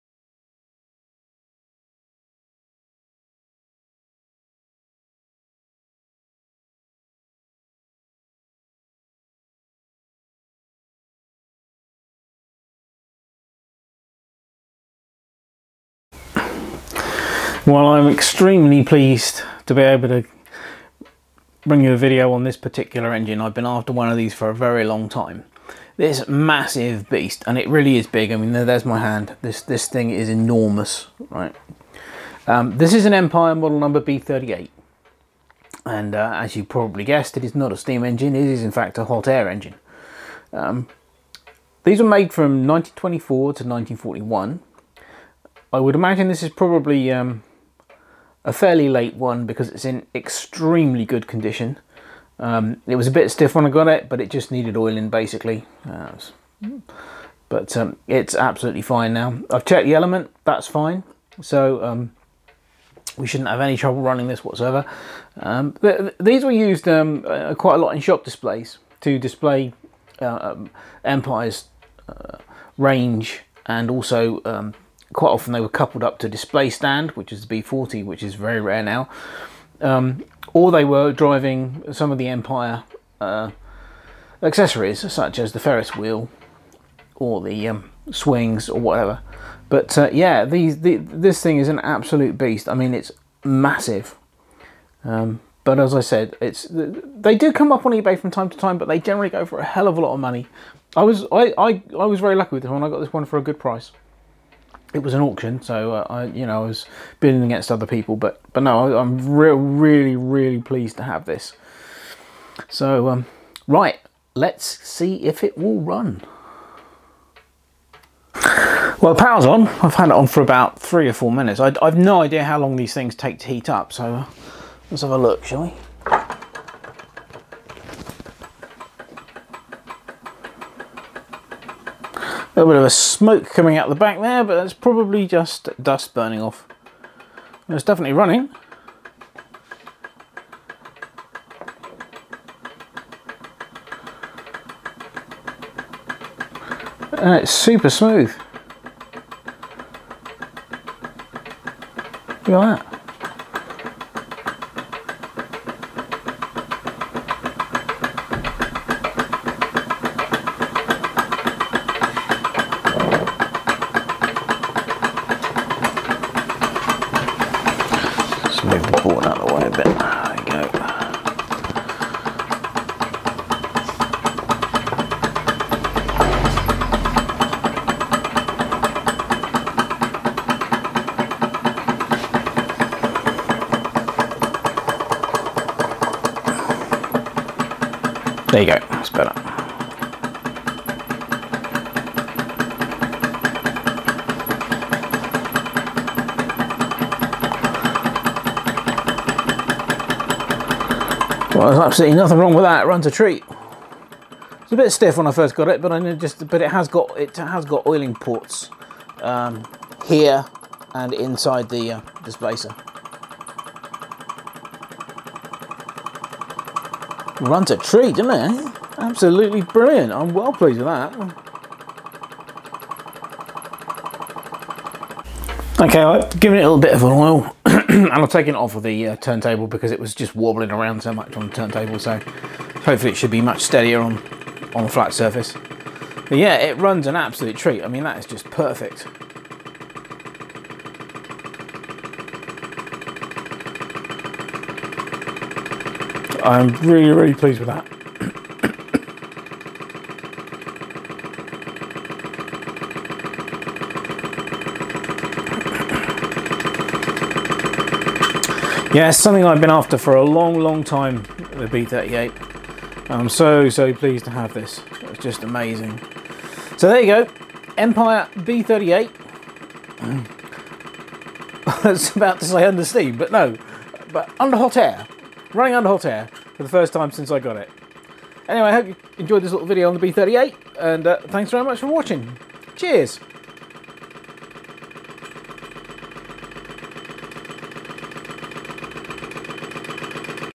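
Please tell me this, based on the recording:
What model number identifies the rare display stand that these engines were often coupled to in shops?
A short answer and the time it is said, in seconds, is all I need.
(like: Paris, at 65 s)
B40, at 77 s.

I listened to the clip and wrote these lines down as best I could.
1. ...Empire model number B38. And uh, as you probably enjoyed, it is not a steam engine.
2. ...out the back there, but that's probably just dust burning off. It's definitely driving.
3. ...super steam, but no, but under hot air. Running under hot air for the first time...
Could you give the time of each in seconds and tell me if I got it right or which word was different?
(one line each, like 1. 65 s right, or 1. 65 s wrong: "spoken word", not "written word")
1. 33 s wrong: "guessed", not "enjoyed"
2. 133 s wrong: "running", not "driving"
3. 272 s wrong: "under", not "super".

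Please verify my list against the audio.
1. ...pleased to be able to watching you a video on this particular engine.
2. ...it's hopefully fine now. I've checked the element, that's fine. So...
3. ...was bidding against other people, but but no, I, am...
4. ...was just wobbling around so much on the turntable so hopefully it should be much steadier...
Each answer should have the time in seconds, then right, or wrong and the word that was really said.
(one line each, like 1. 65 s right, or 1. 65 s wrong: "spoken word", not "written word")
1. 18 s wrong: "bring", not "watching"
2. 58 s wrong: "absolutely", not "hopefully"
3. 106 s right
4. 229 s right.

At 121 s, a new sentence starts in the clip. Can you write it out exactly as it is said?
I, I've no idea how long these things take to heat up, so uh, let's have a look, shall we?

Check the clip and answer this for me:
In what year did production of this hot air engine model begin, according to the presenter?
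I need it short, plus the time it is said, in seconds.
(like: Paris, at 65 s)
1924, at 42 s.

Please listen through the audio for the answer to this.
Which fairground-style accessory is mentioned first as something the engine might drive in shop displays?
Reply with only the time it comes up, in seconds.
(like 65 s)
85 s.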